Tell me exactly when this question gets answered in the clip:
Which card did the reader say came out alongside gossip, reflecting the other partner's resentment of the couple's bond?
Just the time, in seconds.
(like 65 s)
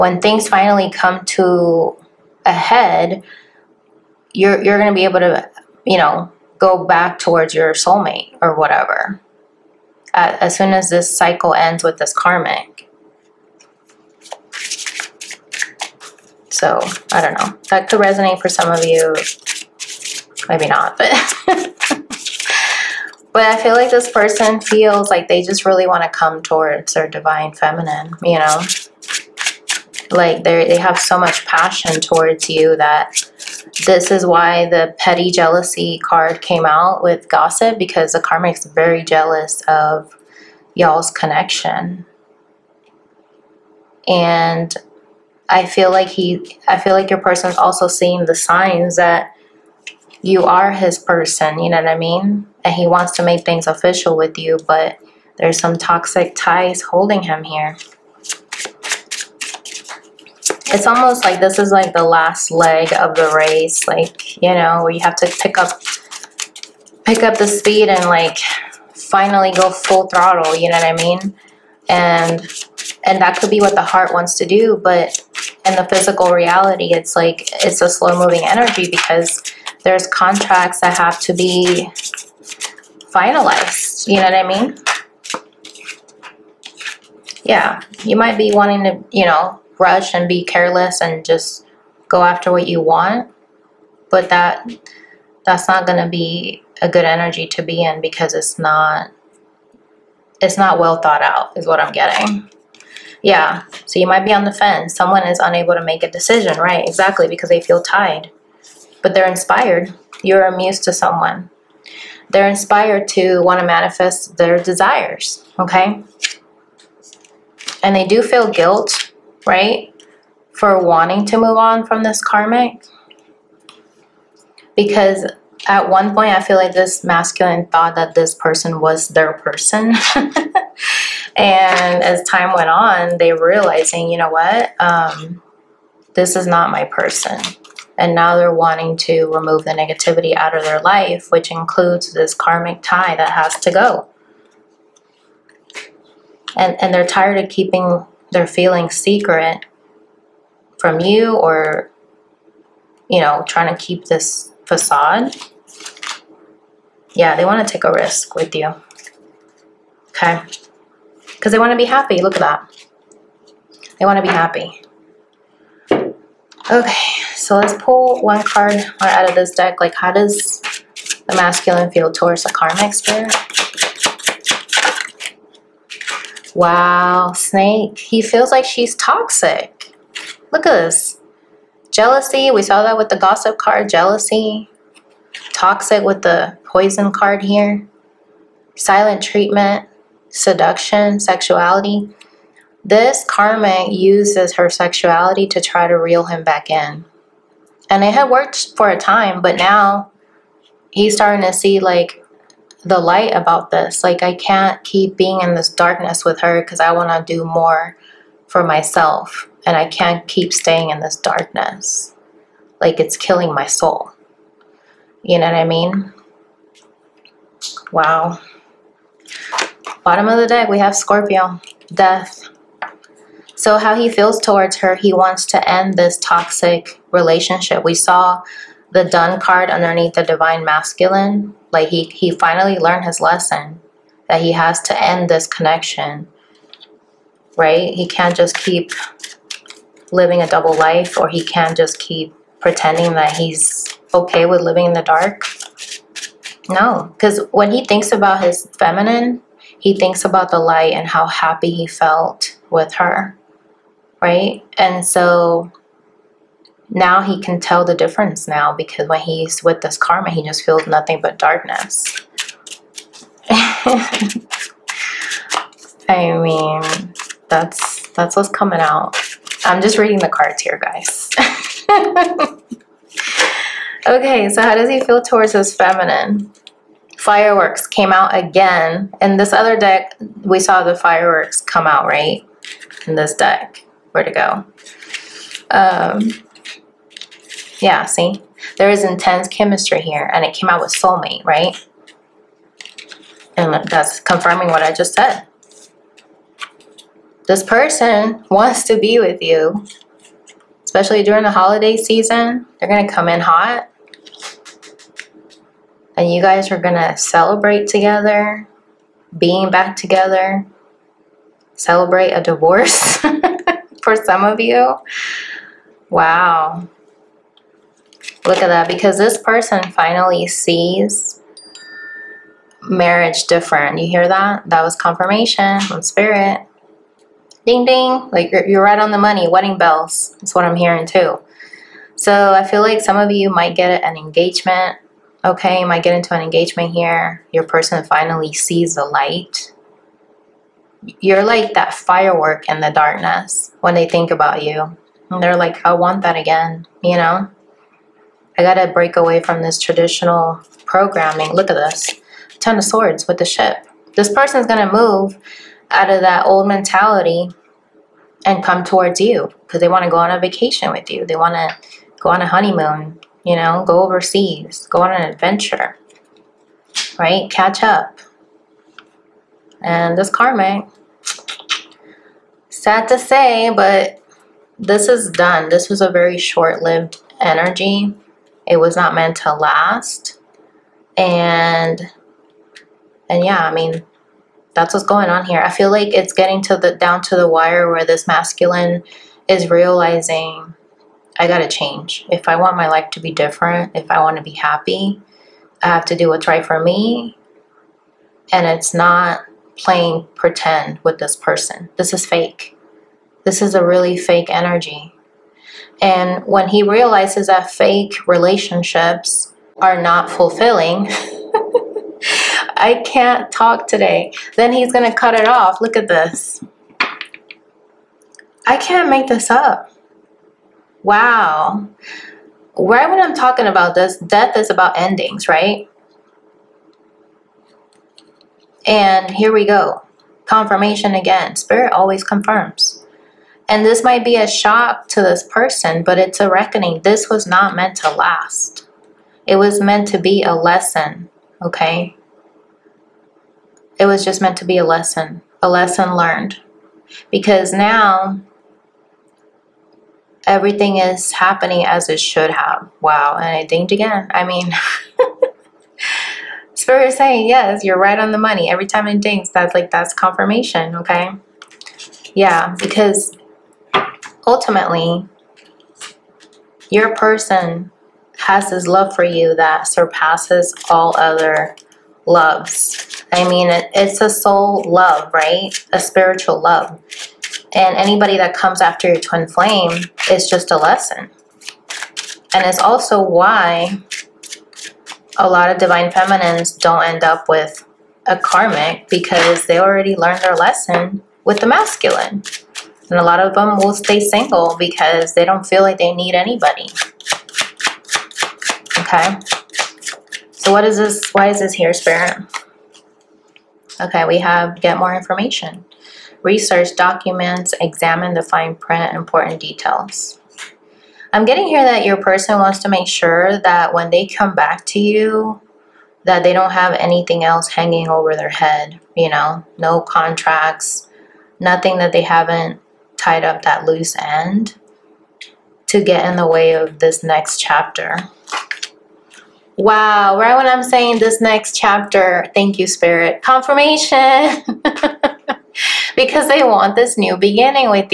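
34 s.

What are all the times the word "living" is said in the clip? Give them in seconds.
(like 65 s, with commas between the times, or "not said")
240 s, 244 s.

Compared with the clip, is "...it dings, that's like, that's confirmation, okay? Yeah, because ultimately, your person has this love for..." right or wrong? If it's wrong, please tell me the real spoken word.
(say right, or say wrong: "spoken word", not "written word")
right.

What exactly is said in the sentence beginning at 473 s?
I mean, it, it's a soul love, right?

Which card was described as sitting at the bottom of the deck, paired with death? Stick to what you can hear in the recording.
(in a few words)
Scorpio.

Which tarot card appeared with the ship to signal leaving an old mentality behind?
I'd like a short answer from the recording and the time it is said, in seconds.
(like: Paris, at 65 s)
Ten of Swords, at 352 s.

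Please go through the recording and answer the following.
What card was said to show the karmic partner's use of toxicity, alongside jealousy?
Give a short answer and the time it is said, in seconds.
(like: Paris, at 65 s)
the poison card, at 186 s.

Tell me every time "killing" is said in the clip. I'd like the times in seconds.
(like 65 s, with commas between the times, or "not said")
213 s.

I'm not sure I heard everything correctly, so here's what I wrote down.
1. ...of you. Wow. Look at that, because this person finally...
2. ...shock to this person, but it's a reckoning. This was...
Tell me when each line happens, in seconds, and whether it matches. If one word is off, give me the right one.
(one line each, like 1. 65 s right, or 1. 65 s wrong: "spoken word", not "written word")
1. 314 s right
2. 434 s right.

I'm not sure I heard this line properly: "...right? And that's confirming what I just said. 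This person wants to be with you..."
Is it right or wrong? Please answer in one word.
right.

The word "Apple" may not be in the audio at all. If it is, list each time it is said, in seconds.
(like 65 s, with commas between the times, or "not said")
not said.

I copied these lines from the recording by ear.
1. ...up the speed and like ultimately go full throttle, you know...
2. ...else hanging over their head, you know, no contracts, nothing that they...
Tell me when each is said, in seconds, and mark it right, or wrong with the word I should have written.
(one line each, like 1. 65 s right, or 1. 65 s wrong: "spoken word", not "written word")
1. 67 s wrong: "finally", not "ultimately"
2. 517 s right.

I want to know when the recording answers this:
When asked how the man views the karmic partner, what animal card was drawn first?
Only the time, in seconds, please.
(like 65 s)
177 s.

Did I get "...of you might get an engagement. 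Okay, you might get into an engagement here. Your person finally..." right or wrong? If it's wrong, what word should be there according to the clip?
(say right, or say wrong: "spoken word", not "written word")
right.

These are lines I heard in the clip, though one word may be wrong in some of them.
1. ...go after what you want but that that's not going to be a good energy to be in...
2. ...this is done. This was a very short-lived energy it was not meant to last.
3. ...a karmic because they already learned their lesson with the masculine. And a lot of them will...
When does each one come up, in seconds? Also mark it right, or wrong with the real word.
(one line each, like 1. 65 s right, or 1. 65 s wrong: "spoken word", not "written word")
1. 92 s right
2. 374 s right
3. 488 s right.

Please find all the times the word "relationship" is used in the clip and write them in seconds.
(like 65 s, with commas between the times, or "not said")
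227 s, 408 s.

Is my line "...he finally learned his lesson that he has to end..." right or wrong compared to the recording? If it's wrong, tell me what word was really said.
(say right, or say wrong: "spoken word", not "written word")
right.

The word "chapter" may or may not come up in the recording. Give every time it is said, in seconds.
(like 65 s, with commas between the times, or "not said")
527 s, 531 s.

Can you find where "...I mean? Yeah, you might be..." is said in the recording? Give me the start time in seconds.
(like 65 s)
84 s.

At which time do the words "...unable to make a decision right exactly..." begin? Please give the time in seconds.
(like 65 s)
105 s.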